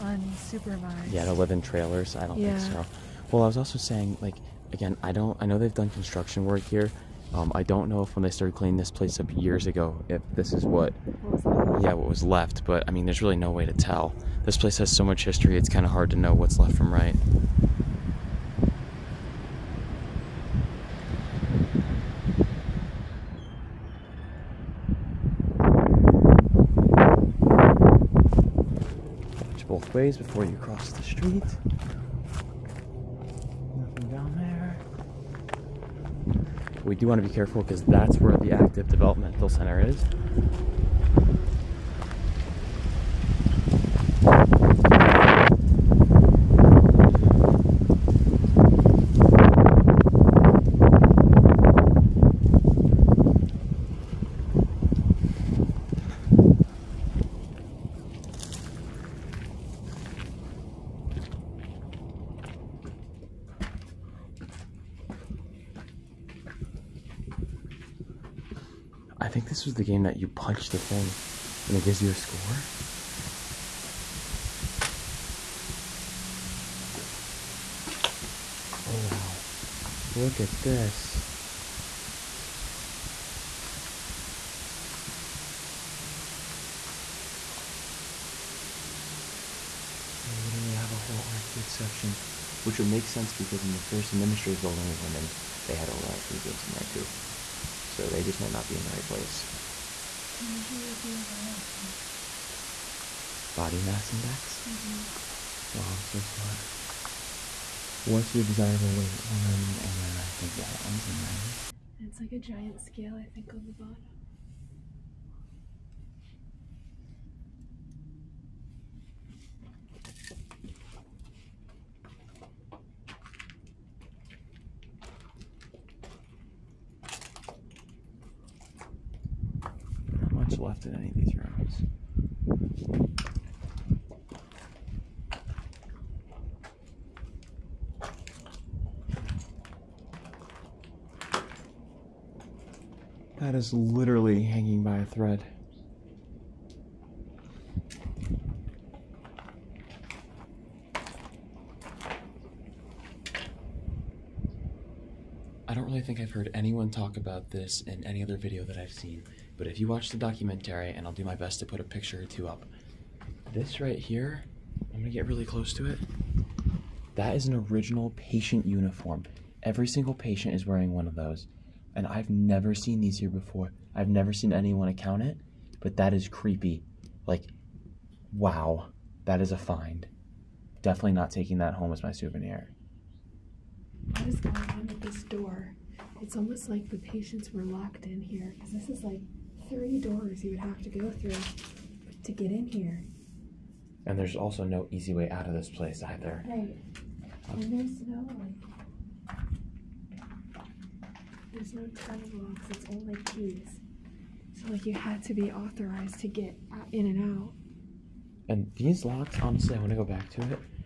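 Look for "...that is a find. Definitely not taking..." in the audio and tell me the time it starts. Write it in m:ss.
2:59.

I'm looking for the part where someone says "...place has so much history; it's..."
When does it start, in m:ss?
0:14.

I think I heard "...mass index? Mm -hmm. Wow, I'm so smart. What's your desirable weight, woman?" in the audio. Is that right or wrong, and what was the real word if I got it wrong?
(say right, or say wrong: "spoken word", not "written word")
right.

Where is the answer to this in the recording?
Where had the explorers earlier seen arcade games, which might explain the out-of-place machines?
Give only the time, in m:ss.
1:33.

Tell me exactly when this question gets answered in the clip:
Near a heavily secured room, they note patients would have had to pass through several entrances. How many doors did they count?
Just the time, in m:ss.
3:09.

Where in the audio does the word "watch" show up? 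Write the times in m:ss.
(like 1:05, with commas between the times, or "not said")
0:29, 2:39.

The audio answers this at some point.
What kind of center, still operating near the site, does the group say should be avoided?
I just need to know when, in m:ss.
0:38.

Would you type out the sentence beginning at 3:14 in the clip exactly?
And there's also no easy way out of this place either.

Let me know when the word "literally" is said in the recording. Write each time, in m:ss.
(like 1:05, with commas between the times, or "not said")
1:30, 2:23.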